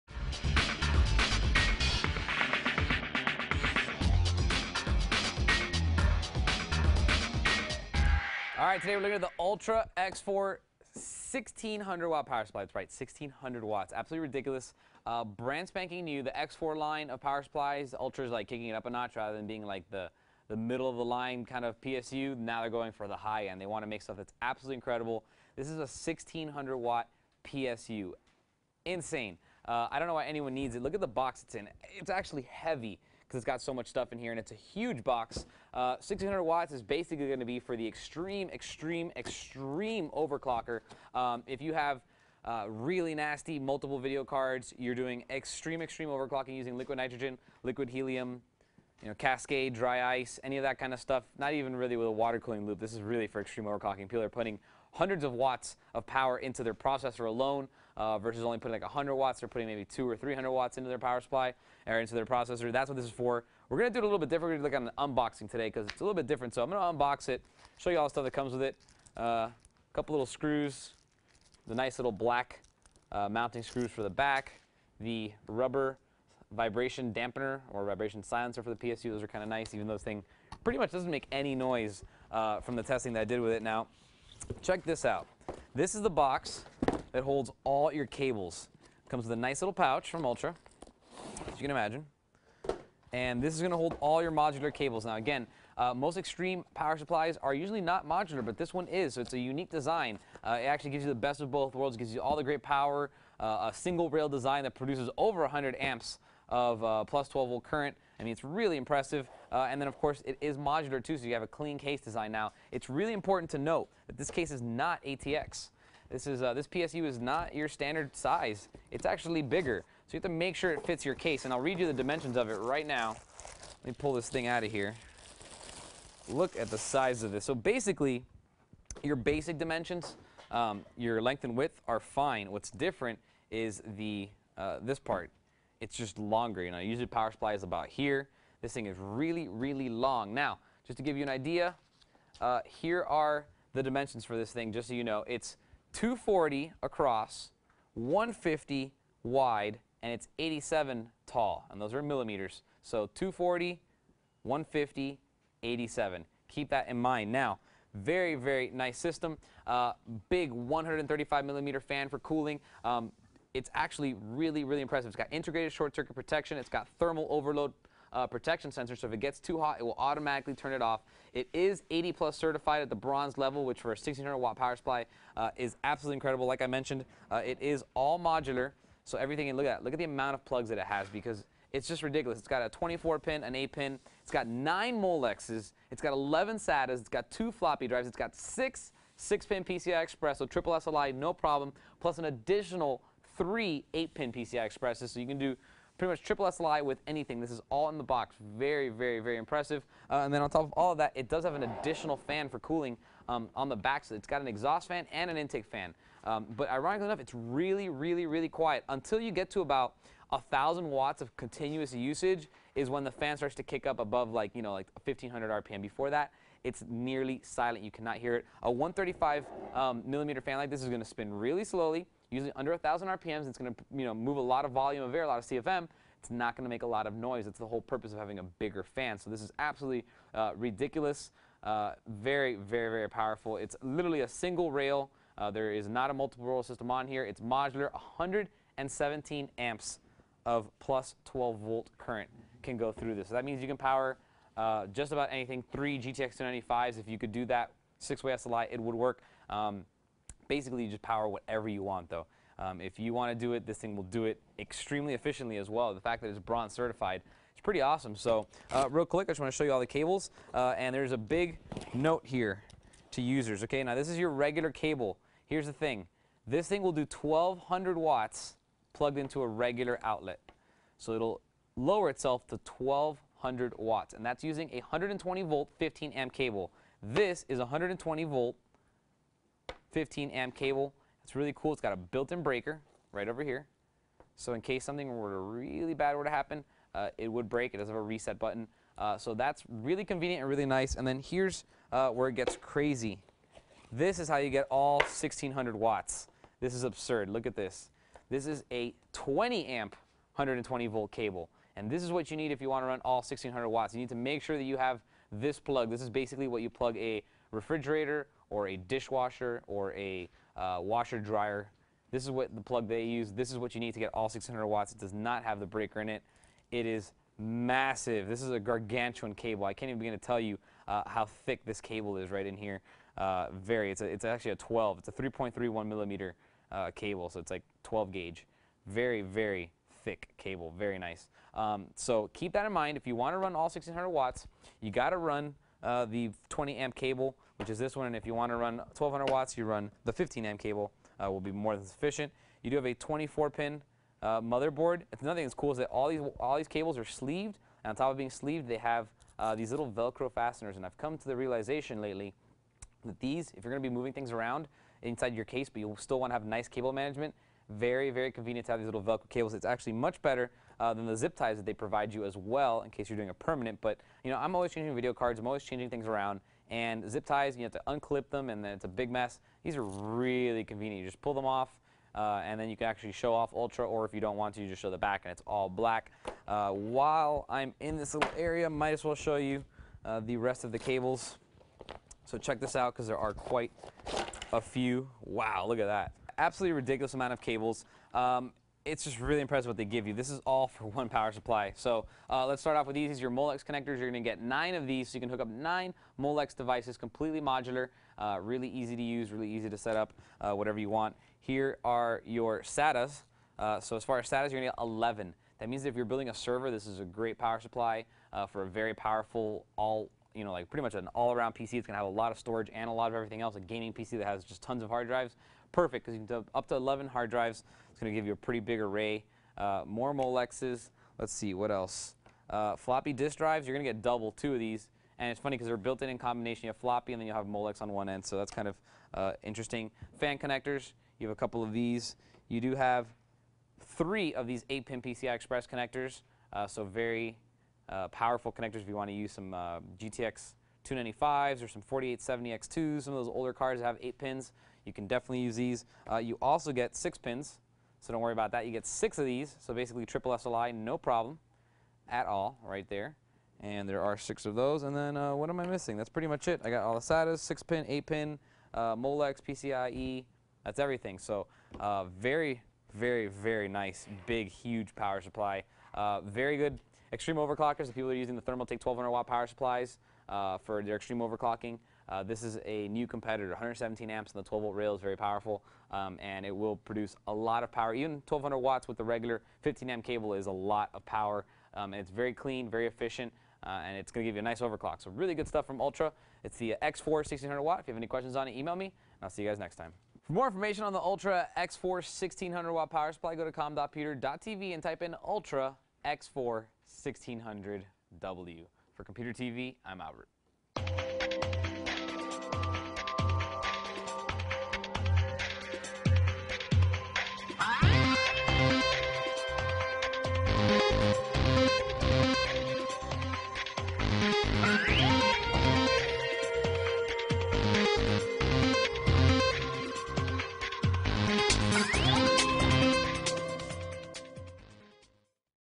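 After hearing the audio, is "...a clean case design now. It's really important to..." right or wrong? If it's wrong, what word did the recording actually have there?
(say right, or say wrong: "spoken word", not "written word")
right.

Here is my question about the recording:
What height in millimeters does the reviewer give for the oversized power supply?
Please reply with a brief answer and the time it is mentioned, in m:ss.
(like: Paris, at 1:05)
87, at 2:30.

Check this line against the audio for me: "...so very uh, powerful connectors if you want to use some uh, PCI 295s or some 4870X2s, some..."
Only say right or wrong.
wrong.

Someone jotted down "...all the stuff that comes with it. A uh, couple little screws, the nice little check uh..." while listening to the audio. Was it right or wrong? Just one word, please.
wrong.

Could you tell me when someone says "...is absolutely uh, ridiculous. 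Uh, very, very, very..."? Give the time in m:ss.
3:49.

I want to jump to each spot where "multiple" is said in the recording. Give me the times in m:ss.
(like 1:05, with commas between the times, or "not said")
0:43, 3:56.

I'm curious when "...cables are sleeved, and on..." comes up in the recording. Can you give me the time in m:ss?
5:46.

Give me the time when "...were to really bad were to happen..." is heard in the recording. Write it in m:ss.
4:45.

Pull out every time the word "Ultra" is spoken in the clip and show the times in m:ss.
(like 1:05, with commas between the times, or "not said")
0:09, 0:17, 1:30, 6:13, 8:05, 8:10, 8:15.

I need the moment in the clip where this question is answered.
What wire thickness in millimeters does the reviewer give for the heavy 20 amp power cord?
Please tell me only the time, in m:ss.
5:25.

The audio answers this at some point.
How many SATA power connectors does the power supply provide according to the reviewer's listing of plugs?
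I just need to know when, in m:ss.
3:06.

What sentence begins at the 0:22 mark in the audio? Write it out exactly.
Now they're going for the high end.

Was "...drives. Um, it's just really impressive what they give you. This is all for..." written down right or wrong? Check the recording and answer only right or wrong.
wrong.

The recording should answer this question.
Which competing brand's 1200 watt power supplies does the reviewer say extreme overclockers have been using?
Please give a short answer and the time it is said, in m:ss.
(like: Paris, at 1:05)
Thermaltake, at 7:48.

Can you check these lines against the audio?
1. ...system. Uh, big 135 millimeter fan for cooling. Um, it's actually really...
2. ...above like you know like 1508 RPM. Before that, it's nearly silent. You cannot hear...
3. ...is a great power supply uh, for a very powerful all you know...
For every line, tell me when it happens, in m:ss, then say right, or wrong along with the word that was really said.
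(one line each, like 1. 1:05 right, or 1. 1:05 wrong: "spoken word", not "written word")
1. 2:38 right
2. 3:33 wrong: "1500", not "1508"
3. 6:46 right.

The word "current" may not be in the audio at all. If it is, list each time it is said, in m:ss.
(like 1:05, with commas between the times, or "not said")
1:47, 4:01.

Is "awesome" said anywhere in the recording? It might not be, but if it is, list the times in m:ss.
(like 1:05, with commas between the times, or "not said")
4:17.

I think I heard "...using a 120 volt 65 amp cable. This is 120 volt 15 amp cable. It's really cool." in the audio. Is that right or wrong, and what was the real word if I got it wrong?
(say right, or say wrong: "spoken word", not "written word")
wrong: "15", not "65".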